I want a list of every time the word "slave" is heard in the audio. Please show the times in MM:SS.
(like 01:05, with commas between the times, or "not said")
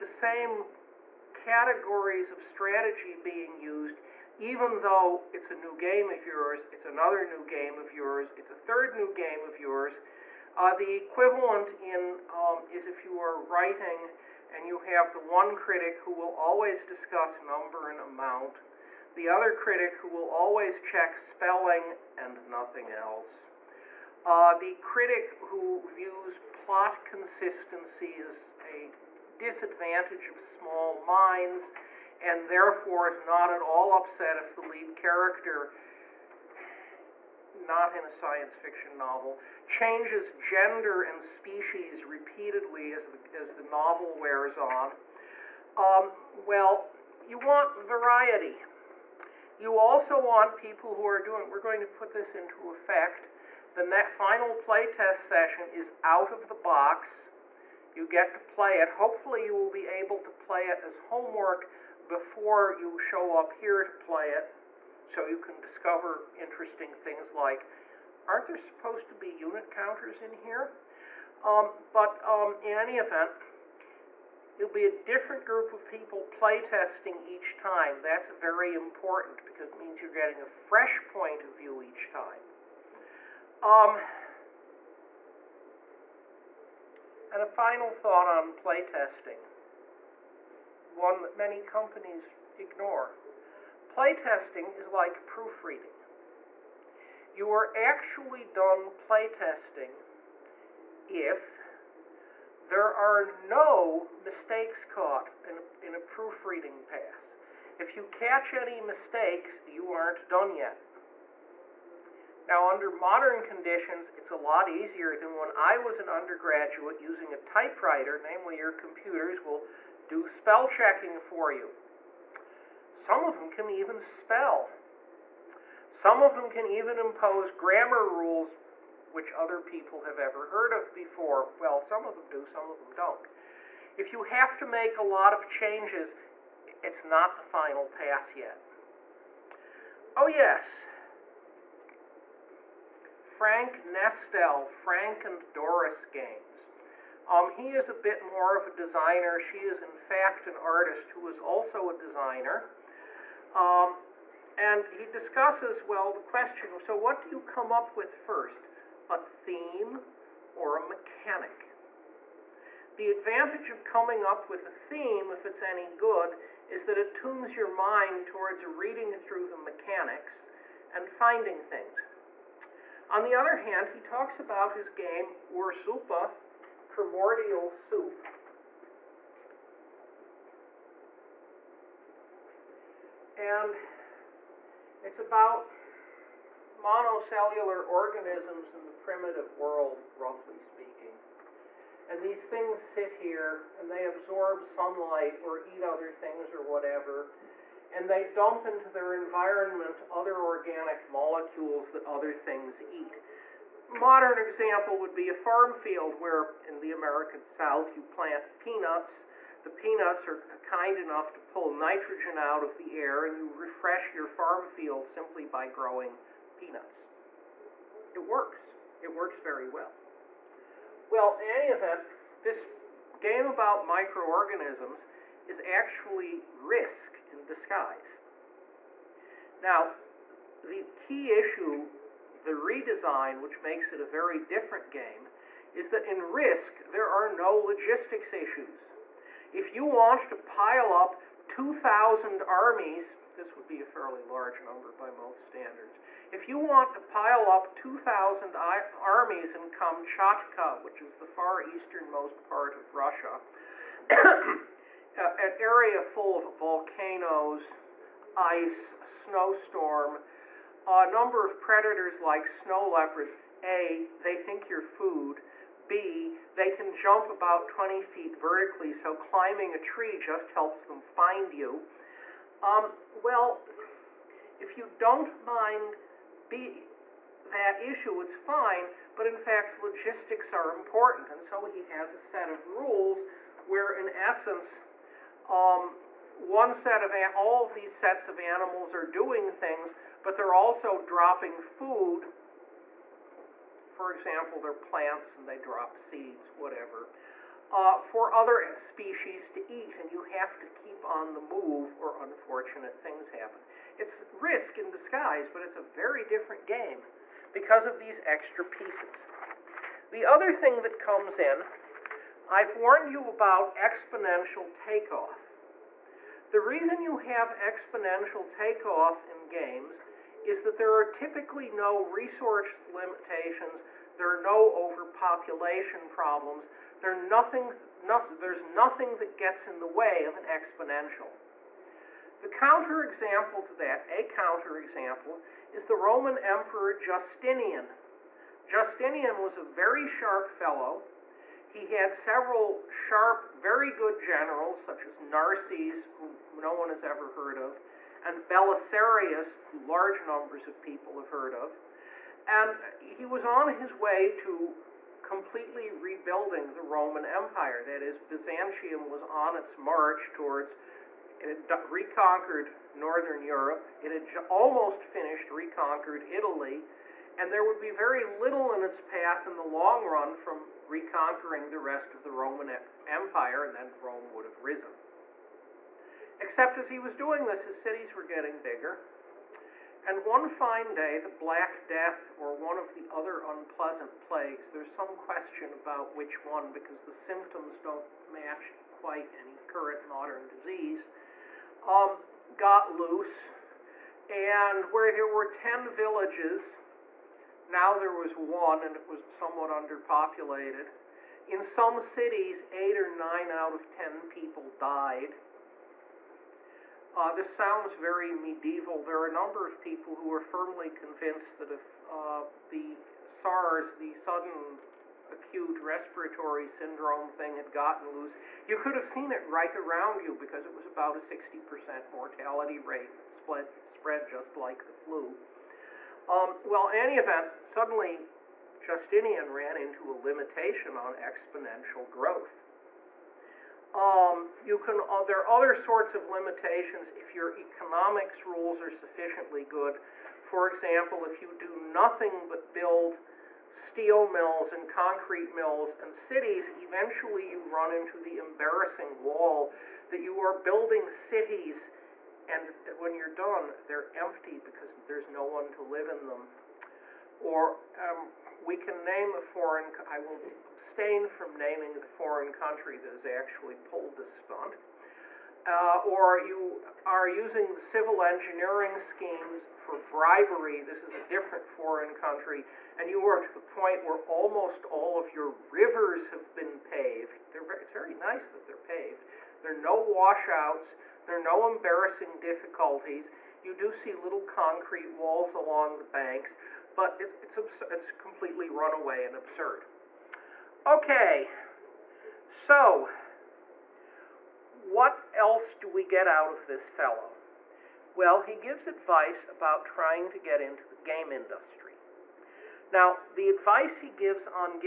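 not said.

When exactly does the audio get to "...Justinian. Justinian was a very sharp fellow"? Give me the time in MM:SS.
05:36.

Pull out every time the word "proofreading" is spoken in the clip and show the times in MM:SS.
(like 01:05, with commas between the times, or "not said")
01:35, 01:45.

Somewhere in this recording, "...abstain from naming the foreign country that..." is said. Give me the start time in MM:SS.
07:40.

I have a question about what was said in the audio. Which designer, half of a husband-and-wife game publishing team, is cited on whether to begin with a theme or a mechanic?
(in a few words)
Frank Nestel.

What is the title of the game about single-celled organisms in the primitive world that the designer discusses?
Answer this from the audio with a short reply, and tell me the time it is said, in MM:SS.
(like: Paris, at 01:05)
Ursuppe, at 02:55.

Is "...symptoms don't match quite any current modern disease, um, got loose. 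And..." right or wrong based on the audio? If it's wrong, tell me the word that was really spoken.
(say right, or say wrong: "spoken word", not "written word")
right.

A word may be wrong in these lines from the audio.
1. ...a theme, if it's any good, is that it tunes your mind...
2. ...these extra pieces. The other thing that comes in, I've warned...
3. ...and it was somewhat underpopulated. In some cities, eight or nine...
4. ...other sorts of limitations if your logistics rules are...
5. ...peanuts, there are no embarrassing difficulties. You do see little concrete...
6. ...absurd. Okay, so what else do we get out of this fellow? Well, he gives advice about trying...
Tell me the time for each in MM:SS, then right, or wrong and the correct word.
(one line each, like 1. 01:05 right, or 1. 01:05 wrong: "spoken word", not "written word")
1. 02:44 right
2. 05:07 right
3. 06:38 right
4. 07:15 wrong: "economics", not "logistics"
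5. 07:59 wrong: "washouts", not "peanuts"
6. 08:09 right.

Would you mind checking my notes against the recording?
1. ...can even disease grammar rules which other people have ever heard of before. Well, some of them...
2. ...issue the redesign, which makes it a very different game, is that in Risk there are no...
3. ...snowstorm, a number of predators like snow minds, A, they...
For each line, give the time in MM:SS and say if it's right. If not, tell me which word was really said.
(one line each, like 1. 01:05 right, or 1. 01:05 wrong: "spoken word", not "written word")
1. 02:06 wrong: "impose", not "disease"
2. 03:51 right
3. 04:19 wrong: "leopards", not "minds".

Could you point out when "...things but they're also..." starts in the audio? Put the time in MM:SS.
04:49.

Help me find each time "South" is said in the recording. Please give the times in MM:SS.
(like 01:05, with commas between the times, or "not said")
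03:27.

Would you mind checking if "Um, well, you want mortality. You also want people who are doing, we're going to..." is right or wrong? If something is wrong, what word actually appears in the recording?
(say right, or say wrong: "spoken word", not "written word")
wrong: "variety", not "mortality".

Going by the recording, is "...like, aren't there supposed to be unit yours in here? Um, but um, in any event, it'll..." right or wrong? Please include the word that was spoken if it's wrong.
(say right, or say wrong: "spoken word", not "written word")
wrong: "counters", not "yours".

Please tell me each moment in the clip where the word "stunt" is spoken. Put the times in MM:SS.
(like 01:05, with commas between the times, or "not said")
07:44.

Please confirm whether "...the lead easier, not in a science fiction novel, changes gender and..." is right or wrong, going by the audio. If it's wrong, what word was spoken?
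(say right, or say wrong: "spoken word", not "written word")
wrong: "character", not "easier".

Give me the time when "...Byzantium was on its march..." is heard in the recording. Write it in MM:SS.
05:58.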